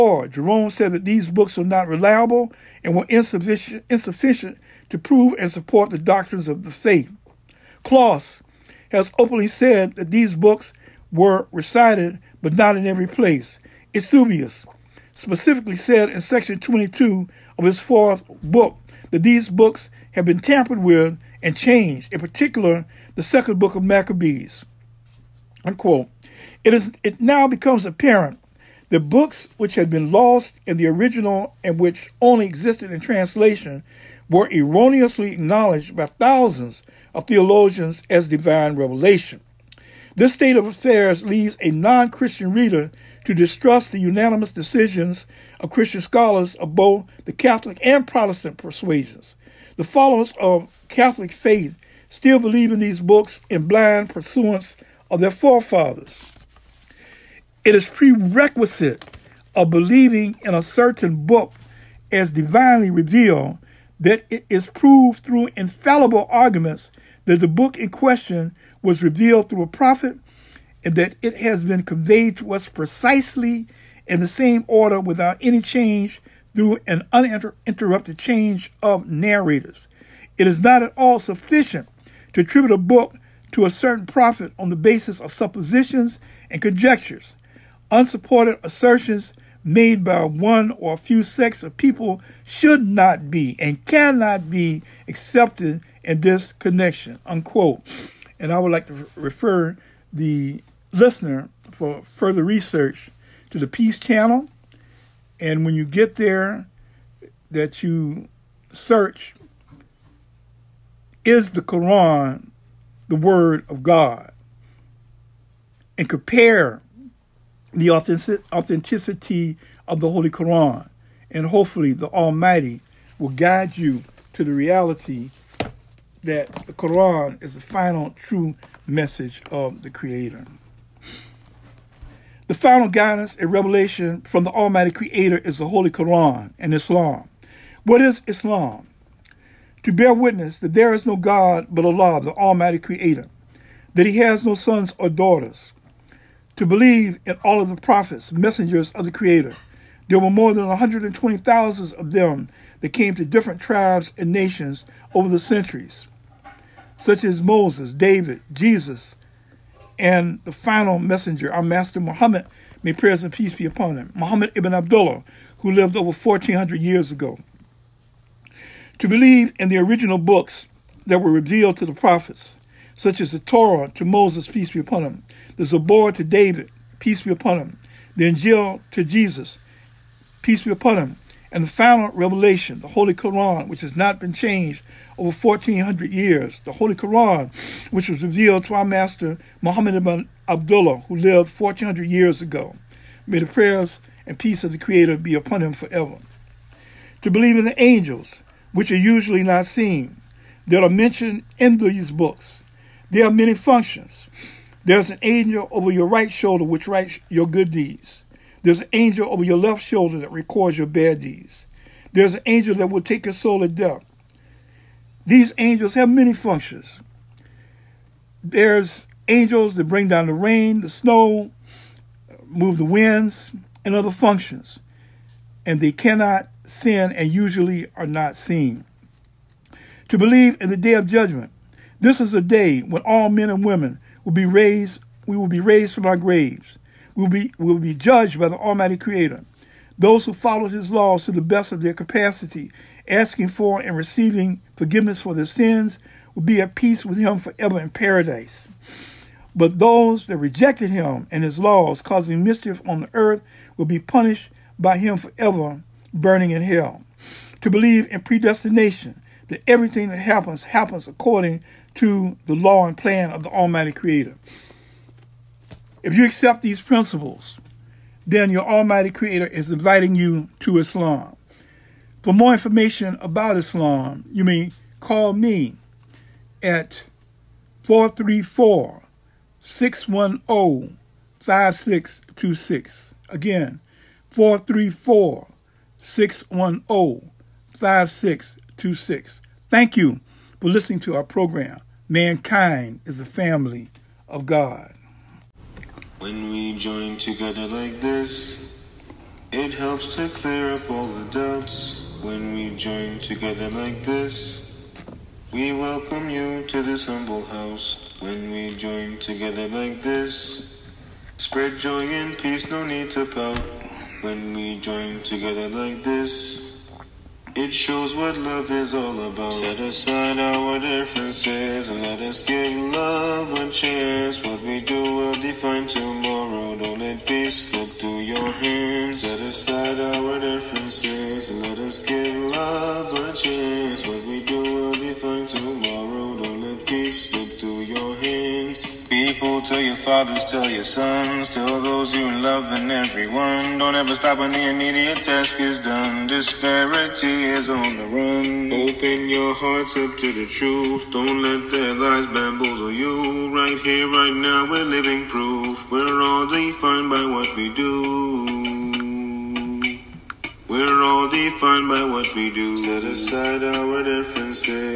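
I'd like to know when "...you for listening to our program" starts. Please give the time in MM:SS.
04:49.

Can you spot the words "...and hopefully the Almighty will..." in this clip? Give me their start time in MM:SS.
02:01.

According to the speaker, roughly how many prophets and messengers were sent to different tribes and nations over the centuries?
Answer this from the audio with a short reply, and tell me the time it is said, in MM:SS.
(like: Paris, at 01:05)
More than 120,000, at 02:30.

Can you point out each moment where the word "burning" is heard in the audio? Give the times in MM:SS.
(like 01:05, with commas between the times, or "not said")
04:16.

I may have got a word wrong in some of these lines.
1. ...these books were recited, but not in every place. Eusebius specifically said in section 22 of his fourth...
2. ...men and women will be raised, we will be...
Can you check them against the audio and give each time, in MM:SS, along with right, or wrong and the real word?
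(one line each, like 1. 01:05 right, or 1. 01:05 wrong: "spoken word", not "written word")
1. 00:10 right
2. 03:53 right.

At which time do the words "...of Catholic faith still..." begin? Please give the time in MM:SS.
00:50.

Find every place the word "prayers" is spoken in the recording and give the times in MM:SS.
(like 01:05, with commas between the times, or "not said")
02:42, 03:13.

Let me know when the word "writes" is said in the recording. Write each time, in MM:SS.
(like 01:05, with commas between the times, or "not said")
03:26.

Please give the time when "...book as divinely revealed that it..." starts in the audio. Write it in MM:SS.
01:01.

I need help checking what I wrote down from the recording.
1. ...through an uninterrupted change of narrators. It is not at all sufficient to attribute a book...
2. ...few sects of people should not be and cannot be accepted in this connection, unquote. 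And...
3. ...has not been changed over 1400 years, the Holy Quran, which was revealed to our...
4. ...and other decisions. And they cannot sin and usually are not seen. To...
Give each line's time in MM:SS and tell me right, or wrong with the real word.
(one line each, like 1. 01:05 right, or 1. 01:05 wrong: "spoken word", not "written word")
1. 01:16 right
2. 01:30 right
3. 03:03 right
4. 03:43 wrong: "functions", not "decisions".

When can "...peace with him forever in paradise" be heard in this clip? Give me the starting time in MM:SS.
04:06.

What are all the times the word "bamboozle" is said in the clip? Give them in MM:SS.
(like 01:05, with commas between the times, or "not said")
05:52.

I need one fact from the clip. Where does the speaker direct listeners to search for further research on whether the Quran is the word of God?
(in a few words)
The Peace Channel.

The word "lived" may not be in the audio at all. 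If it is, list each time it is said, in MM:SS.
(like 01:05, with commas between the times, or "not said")
02:45, 03:11.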